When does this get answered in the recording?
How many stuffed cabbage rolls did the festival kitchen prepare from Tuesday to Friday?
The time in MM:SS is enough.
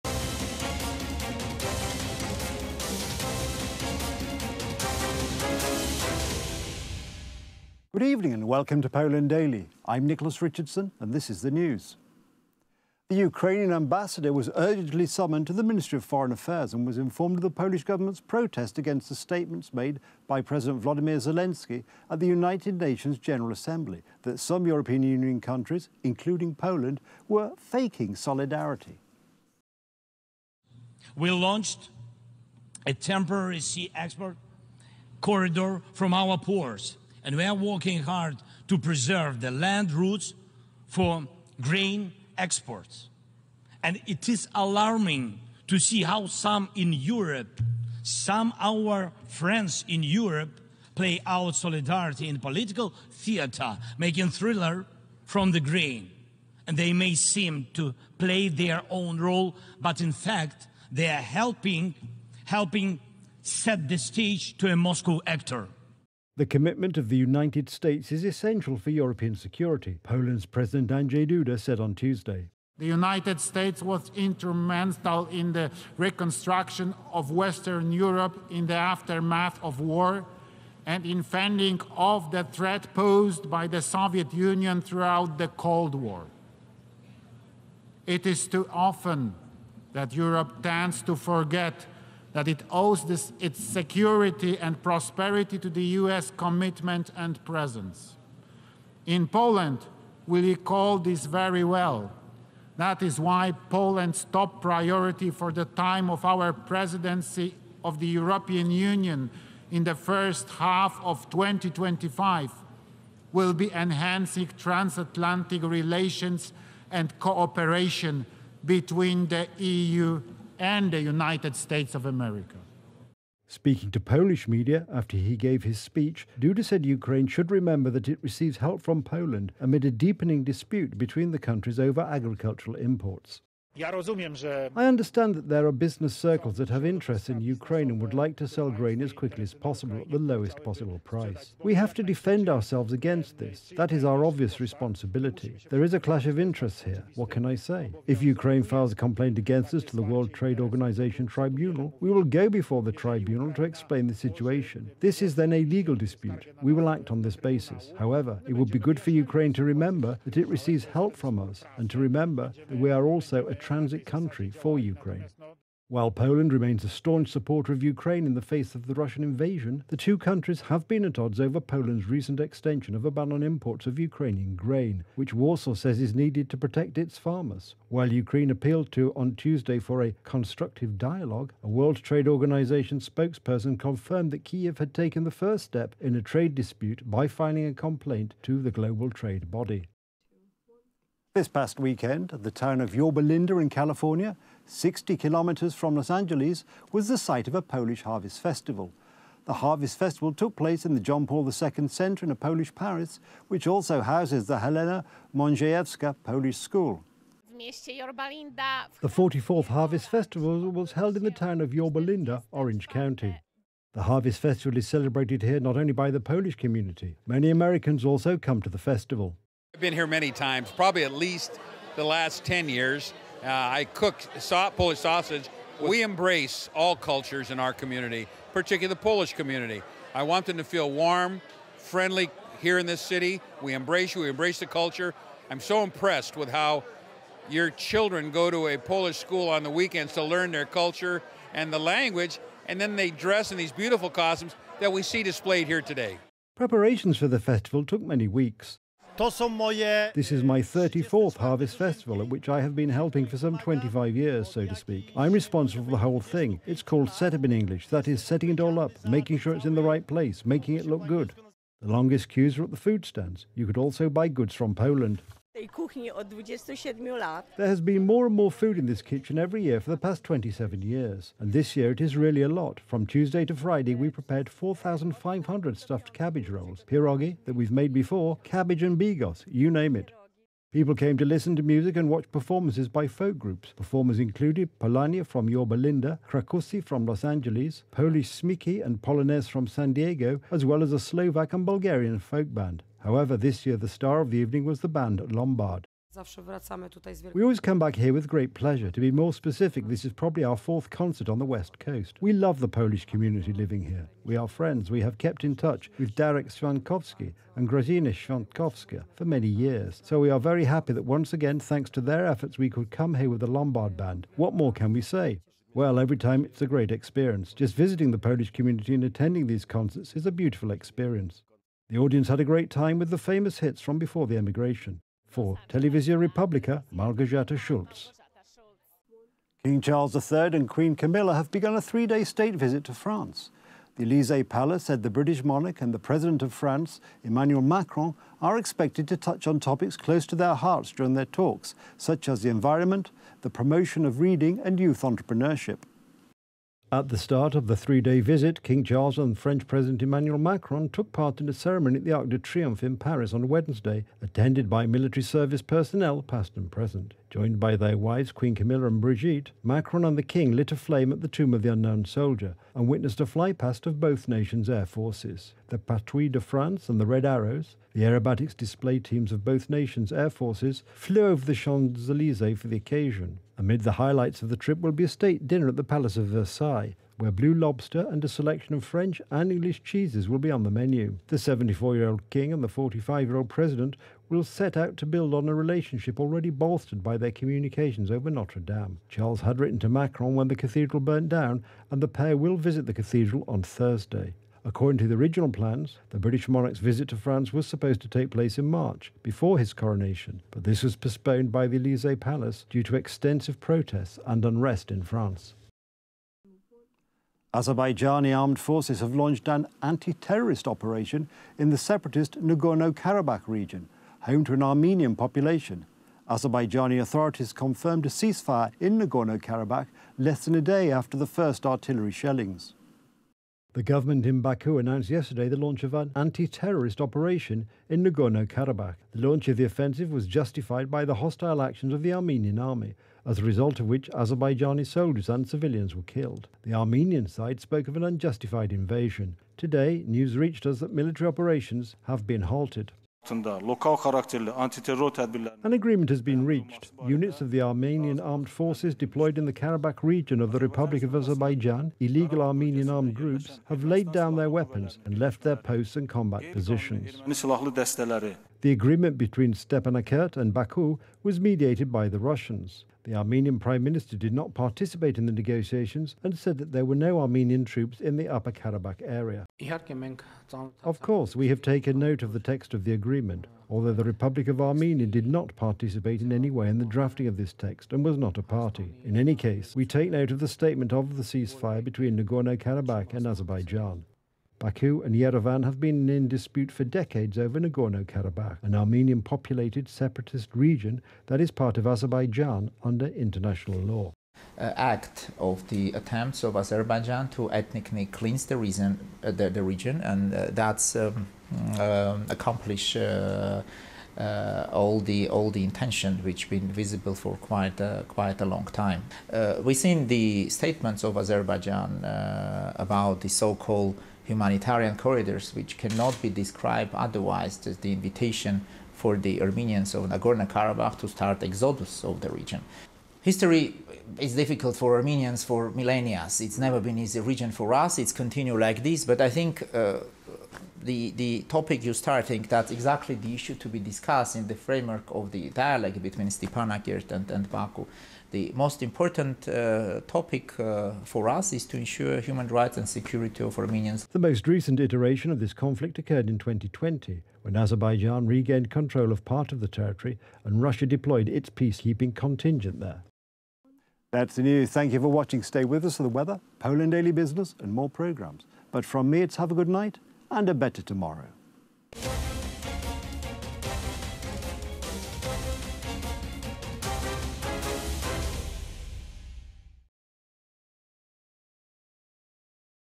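04:34.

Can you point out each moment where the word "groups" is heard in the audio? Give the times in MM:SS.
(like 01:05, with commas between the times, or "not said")
04:43, 07:33.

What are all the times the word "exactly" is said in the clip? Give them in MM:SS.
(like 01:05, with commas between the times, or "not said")
08:52.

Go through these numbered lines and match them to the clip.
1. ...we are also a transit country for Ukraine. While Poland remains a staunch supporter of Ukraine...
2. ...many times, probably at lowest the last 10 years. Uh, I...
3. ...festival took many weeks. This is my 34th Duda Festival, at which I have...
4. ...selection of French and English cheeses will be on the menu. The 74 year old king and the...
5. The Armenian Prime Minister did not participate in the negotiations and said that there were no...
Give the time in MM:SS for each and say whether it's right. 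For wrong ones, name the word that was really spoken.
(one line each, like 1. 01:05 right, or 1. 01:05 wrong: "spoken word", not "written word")
1. 02:42 right
2. 03:40 wrong: "least", not "lowest"
3. 04:07 wrong: "Harvest", not "Duda"
4. 06:18 right
5. 07:43 right.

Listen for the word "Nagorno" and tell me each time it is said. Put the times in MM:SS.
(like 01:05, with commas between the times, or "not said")
06:52, 06:58, 07:08, 08:02, 08:07, 08:40.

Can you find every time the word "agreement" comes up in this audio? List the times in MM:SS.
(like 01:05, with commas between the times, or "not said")
07:25, 07:38, 07:52.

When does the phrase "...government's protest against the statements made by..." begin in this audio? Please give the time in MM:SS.
00:17.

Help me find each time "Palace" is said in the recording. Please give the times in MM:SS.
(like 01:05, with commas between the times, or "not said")
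05:34, 06:15, 06:42.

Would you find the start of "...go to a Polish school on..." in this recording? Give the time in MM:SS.
03:58.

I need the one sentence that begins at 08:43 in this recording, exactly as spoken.
History is difficult for Armenians for millennia.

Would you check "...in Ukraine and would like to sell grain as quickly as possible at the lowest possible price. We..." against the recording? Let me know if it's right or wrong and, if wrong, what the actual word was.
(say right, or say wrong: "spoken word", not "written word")
right.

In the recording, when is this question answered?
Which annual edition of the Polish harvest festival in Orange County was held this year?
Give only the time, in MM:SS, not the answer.
03:29.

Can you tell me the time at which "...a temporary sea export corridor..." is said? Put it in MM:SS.
00:32.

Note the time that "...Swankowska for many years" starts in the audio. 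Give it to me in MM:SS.
05:08.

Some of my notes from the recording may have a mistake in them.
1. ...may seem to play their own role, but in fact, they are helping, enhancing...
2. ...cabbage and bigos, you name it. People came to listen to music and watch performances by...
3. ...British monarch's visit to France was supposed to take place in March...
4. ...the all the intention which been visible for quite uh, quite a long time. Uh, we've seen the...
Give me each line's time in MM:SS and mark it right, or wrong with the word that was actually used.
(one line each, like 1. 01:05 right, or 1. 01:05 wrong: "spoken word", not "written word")
1. 00:56 wrong: "helping", not "enhancing"
2. 04:38 right
3. 06:36 right
4. 08:24 right.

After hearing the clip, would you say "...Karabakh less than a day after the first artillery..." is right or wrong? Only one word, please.
right.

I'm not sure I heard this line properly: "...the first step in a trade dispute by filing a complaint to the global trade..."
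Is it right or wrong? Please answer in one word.
right.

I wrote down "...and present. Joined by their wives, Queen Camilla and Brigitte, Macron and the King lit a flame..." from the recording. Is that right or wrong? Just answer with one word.
right.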